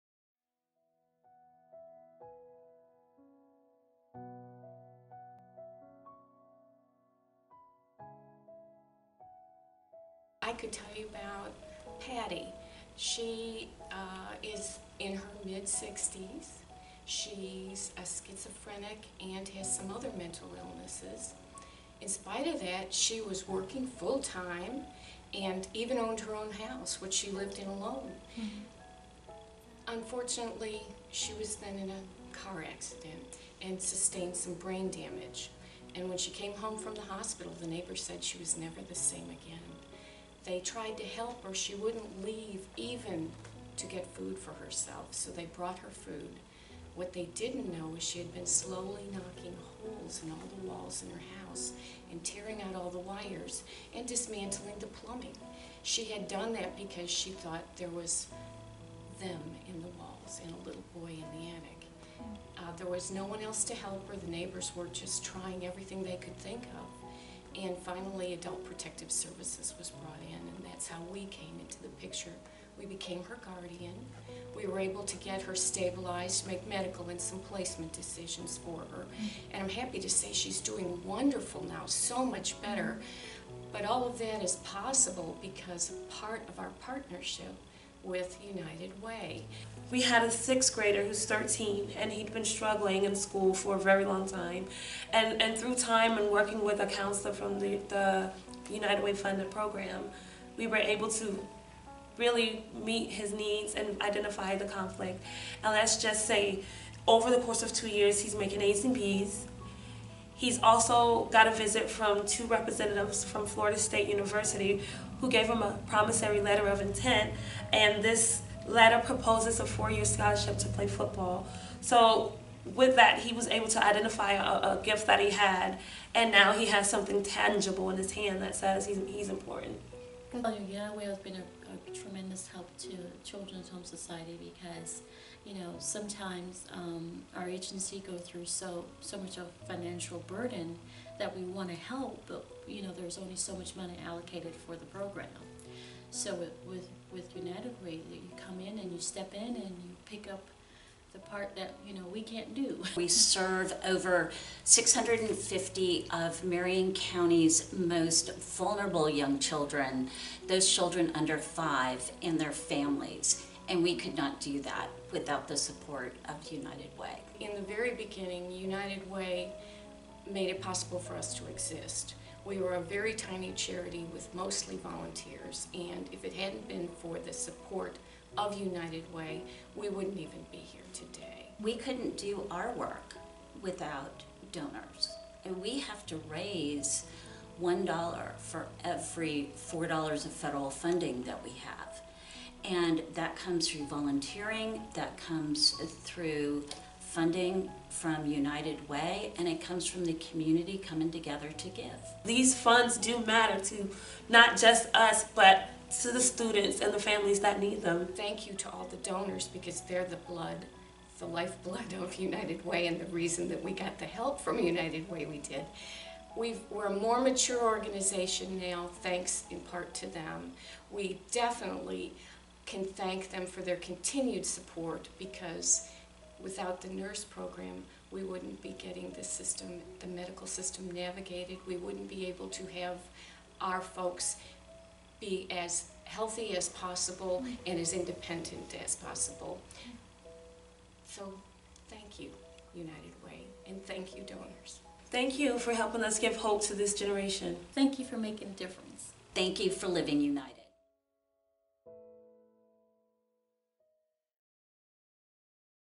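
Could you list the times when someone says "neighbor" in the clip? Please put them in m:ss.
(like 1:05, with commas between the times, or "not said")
0:37, 1:04.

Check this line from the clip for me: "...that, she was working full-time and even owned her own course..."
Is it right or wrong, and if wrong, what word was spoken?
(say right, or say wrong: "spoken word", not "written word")
wrong: "house", not "course".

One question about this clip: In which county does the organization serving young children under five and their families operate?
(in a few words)
Marion County.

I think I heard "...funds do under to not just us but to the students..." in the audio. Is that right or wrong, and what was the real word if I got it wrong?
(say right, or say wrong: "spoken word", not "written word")
wrong: "matter", not "under".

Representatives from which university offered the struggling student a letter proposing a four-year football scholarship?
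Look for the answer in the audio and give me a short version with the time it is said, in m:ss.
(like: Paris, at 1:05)
Florida State University, at 1:53.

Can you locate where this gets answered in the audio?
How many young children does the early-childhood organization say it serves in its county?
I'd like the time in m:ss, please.
2:34.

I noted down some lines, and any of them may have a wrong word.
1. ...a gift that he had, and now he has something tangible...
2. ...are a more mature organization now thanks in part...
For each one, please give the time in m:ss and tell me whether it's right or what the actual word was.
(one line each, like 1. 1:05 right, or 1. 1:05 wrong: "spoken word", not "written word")
1. 2:04 right
2. 3:36 right.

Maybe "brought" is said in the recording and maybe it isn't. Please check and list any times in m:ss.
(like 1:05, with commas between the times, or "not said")
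0:45, 1:09.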